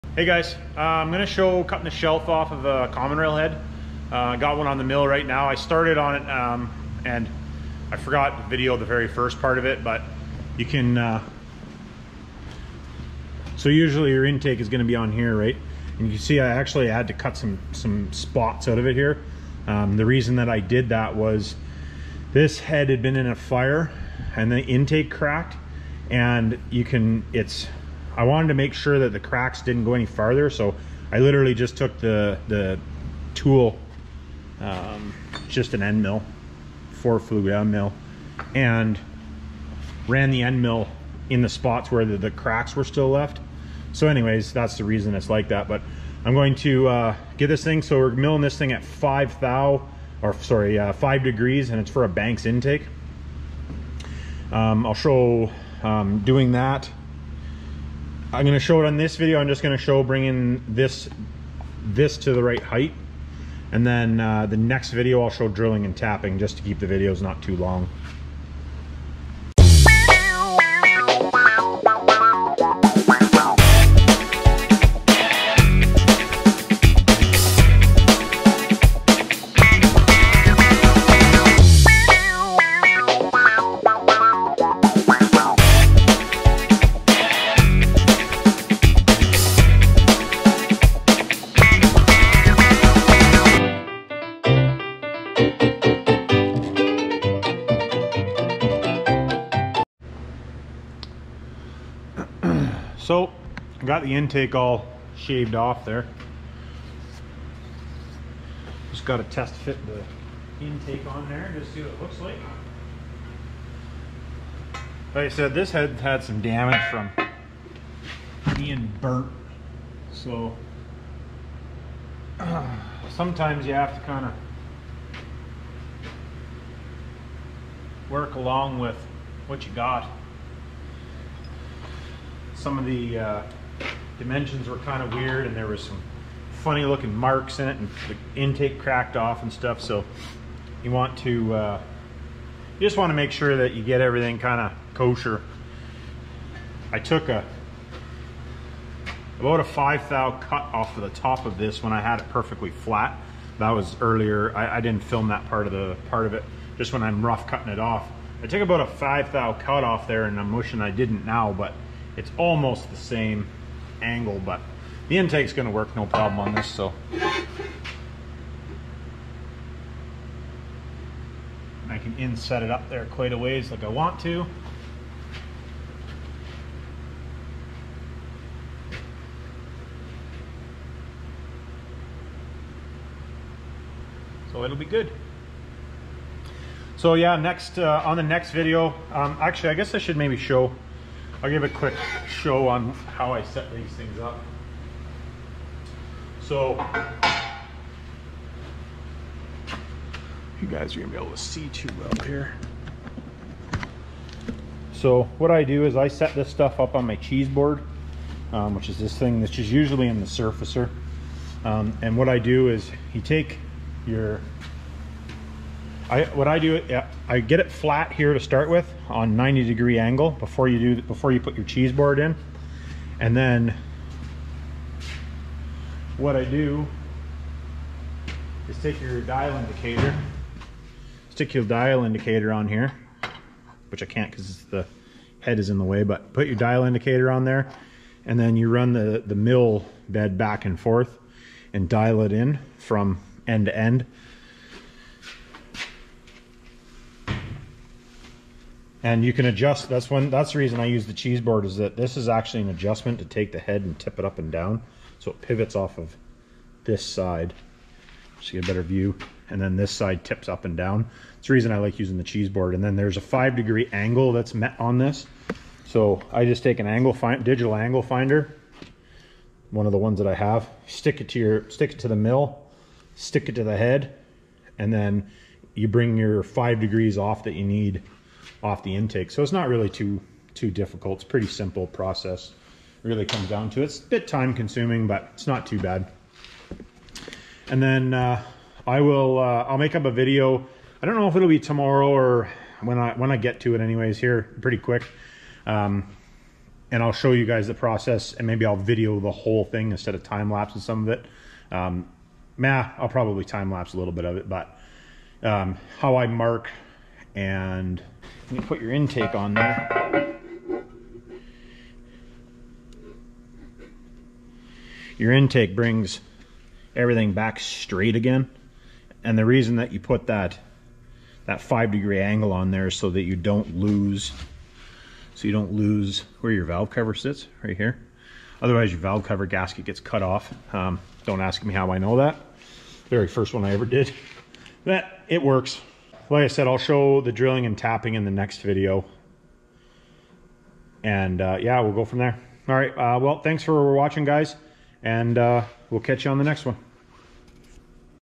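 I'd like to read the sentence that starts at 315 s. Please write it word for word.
Your intake brings everything back straight again.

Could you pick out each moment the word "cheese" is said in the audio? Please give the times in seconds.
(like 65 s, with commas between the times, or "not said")
207 s, 221 s, 251 s, 262 s.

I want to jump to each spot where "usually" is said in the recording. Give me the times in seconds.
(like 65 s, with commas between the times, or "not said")
13 s, 209 s.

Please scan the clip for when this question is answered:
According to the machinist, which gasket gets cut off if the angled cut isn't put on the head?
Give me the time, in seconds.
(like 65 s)
328 s.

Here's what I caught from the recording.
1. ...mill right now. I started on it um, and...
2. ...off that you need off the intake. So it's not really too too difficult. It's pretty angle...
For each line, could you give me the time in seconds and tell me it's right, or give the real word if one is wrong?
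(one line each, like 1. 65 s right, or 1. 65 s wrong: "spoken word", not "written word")
1. 4 s right
2. 277 s wrong: "simple", not "angle".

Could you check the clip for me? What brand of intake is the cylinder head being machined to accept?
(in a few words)
Banks.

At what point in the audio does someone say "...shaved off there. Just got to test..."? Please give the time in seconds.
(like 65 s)
105 s.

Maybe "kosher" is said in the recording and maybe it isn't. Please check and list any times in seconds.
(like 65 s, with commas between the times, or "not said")
144 s.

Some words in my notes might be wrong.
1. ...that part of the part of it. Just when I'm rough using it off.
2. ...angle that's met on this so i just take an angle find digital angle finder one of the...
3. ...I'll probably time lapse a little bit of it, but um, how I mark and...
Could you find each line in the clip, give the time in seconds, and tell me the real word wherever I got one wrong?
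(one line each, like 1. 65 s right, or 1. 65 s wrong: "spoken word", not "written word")
1. 155 s wrong: "cutting", not "using"
2. 263 s right
3. 302 s right.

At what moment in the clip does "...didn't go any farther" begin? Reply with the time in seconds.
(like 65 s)
29 s.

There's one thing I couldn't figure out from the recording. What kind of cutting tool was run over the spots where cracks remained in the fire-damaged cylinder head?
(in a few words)
four flute end mill.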